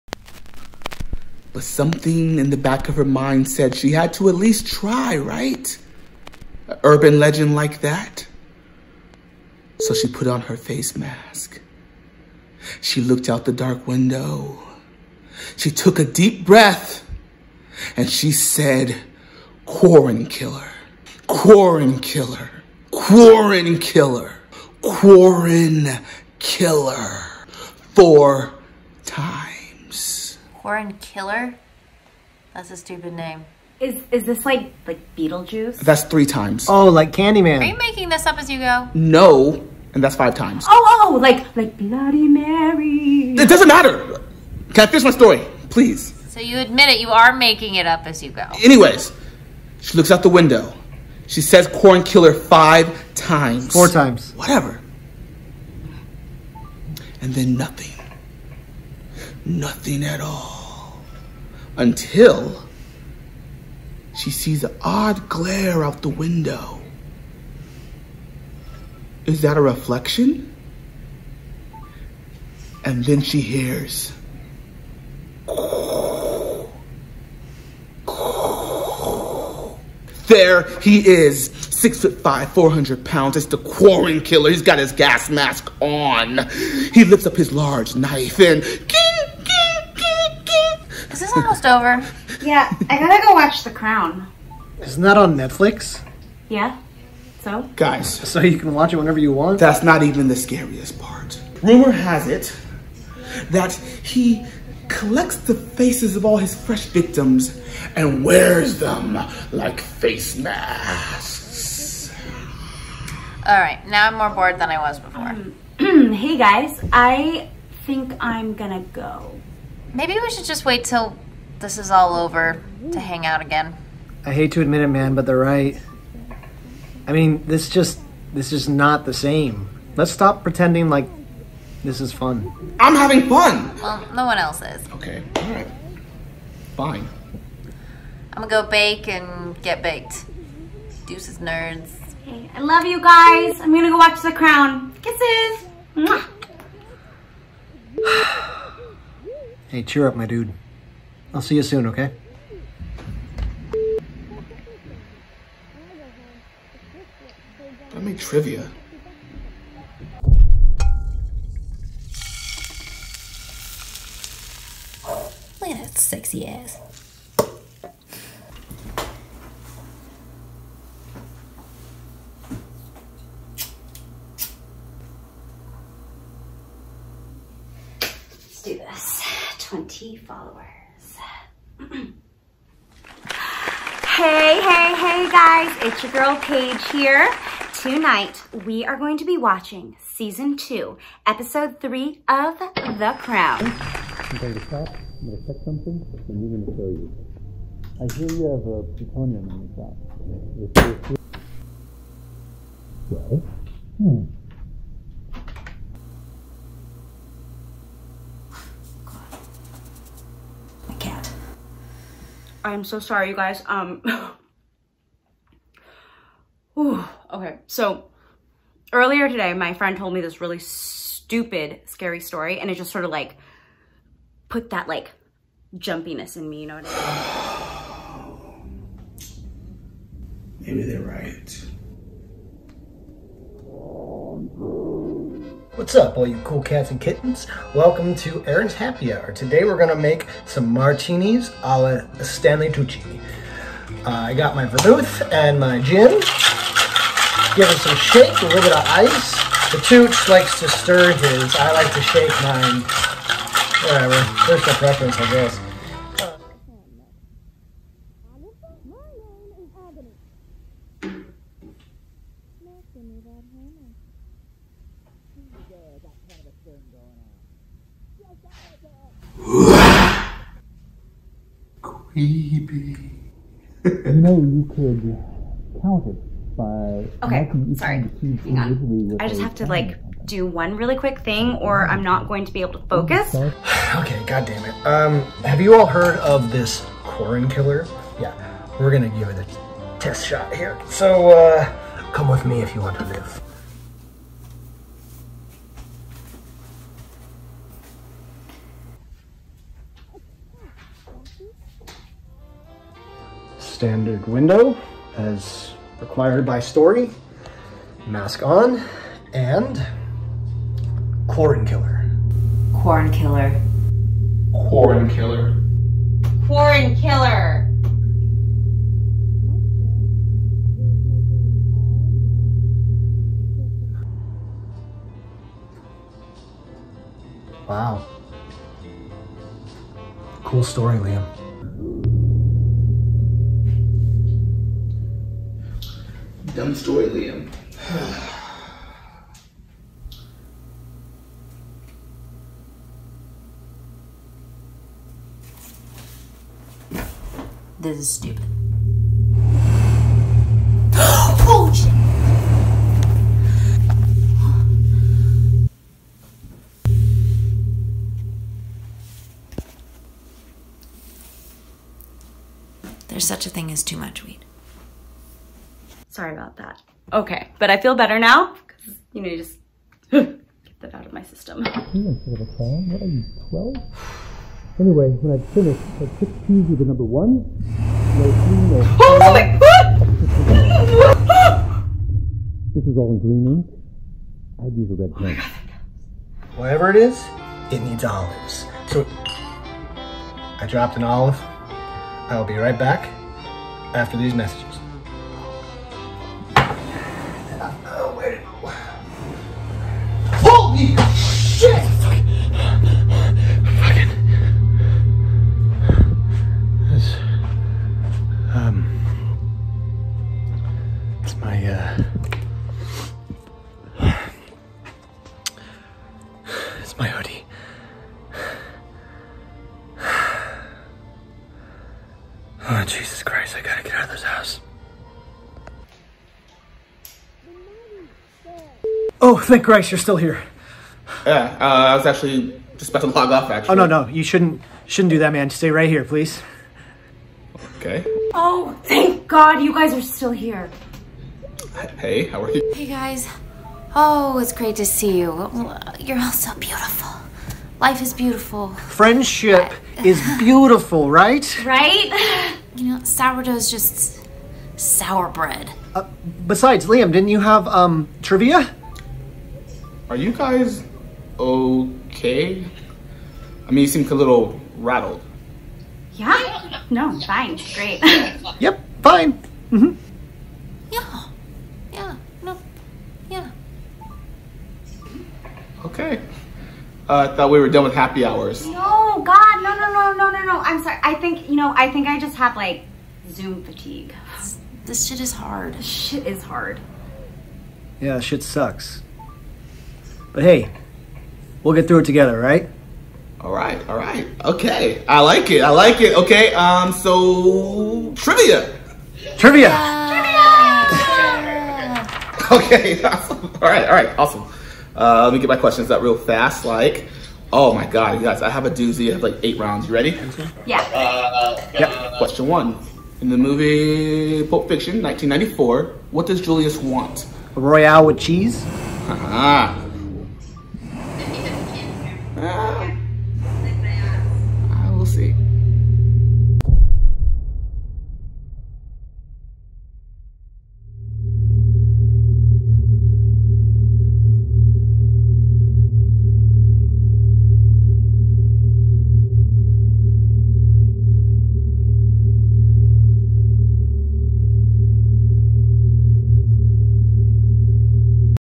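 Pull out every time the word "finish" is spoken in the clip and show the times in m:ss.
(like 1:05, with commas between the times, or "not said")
0:44, 6:15.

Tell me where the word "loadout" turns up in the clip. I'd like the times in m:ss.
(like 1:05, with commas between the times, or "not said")
not said.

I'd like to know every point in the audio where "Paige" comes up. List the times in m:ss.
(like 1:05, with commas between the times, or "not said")
3:06.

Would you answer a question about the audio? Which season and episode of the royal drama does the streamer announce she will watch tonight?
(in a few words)
Season 2, episode 3.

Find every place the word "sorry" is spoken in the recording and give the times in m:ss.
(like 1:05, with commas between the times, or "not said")
3:32, 4:37, 6:06, 8:00.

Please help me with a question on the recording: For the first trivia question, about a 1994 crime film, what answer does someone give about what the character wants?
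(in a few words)
A Royale with cheese.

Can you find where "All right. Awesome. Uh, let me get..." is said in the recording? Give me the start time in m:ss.
8:23.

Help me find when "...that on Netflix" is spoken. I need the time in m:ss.
1:35.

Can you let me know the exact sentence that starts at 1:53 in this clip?
All right, now I'm more bored than I was before.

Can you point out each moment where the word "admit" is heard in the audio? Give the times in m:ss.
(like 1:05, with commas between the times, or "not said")
0:46, 2:04.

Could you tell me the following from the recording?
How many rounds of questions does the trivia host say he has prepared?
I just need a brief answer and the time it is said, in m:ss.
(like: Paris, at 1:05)
8, at 8:29.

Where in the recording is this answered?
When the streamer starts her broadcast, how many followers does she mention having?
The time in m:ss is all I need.
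2:59.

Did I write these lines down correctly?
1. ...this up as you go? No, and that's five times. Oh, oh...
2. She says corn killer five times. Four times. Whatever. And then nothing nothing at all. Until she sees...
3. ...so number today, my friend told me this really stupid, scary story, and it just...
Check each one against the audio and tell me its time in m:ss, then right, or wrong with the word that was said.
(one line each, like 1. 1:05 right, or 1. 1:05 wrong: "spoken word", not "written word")
1. 0:38 right
2. 0:51 right
3. 3:37 wrong: "earlier", not "number".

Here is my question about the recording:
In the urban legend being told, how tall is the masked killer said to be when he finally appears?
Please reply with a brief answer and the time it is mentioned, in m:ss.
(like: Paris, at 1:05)
6 foot 5, at 1:21.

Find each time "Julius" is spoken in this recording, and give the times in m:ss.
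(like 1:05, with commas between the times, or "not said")
8:36.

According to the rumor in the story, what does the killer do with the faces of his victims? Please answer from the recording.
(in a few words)
Wears them like face masks.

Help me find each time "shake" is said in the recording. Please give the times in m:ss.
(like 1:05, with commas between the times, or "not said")
4:07, 4:12.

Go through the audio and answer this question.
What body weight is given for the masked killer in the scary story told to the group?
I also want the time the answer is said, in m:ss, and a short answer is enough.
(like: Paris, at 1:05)
400 pounds, at 1:22.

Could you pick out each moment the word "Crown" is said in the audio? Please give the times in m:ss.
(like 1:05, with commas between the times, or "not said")
1:33, 2:24, 3:13.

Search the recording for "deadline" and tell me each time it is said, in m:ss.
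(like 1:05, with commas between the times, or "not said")
not said.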